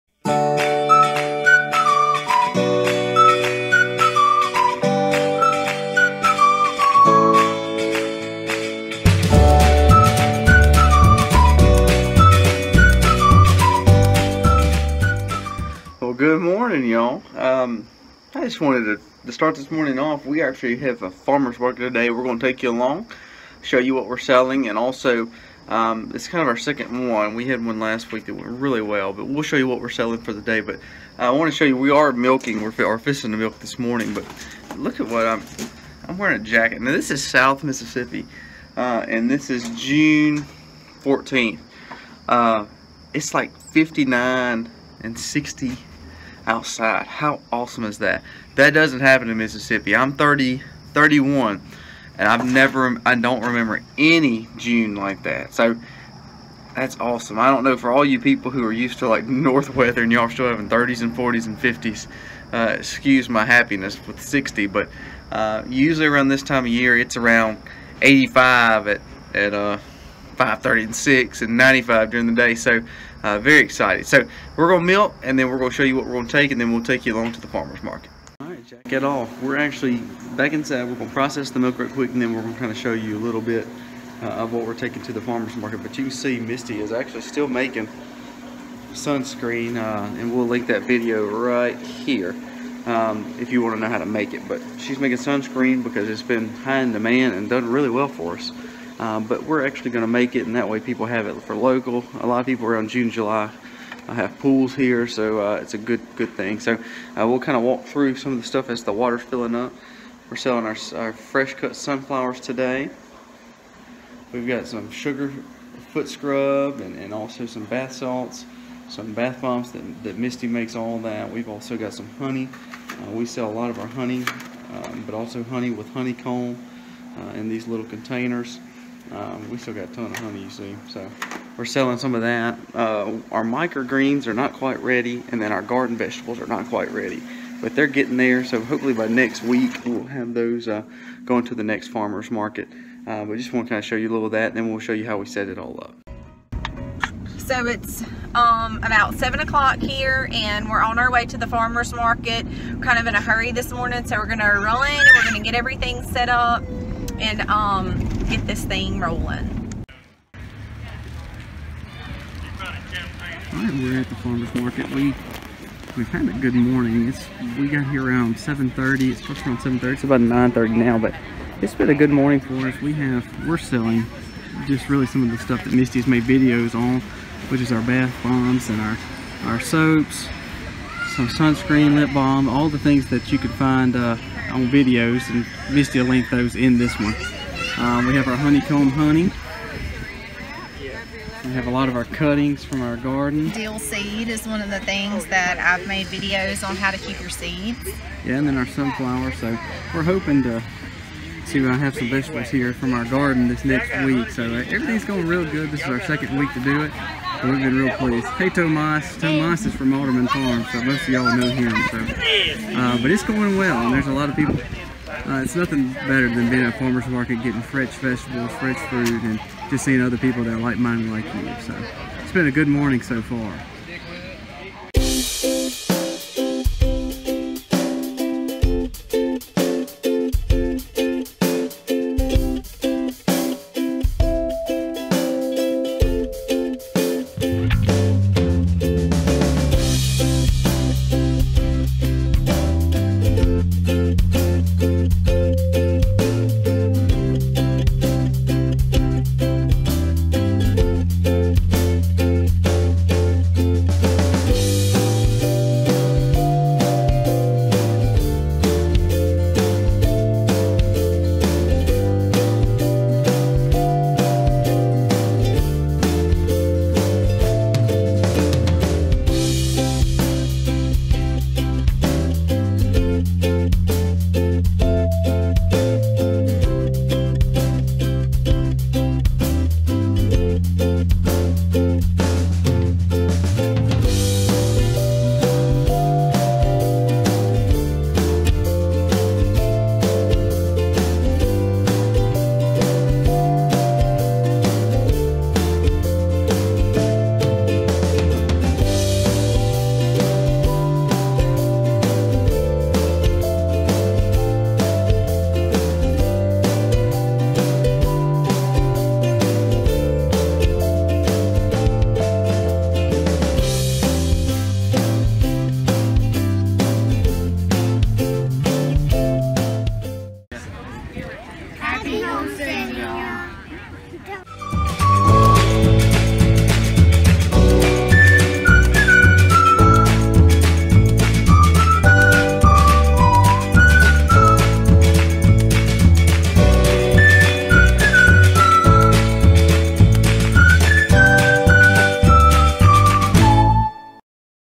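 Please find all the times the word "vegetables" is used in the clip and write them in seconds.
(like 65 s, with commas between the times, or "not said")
135 s, 202 s, 217 s.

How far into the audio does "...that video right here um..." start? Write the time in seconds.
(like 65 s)
90 s.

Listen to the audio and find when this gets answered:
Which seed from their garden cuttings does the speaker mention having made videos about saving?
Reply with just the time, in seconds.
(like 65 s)
193 s.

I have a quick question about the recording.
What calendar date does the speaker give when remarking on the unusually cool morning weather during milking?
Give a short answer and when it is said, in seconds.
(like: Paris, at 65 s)
June 14th, at 39 s.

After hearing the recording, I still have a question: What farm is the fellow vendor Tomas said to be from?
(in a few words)
Alderman Farm.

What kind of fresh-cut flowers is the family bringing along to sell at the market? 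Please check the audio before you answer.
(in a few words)
Sunflowers.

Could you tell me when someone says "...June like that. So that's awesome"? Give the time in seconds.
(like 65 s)
54 s.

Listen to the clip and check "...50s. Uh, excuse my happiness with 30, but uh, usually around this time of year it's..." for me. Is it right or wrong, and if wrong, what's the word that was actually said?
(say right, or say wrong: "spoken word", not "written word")
wrong: "60", not "30".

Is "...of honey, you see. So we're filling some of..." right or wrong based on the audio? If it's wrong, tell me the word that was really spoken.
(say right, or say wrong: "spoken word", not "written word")
wrong: "selling", not "filling".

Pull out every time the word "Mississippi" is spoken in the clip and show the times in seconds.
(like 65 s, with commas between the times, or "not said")
37 s, 49 s.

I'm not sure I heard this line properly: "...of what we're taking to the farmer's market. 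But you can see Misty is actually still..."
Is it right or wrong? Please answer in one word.
right.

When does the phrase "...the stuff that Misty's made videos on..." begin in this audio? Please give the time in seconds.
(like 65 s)
175 s.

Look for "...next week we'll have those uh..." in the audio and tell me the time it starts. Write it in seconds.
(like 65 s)
139 s.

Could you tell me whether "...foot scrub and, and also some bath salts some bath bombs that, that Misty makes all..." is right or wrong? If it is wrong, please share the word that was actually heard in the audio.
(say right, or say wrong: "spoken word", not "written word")
right.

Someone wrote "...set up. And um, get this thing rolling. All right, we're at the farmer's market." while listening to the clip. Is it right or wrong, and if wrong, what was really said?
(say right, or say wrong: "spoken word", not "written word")
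right.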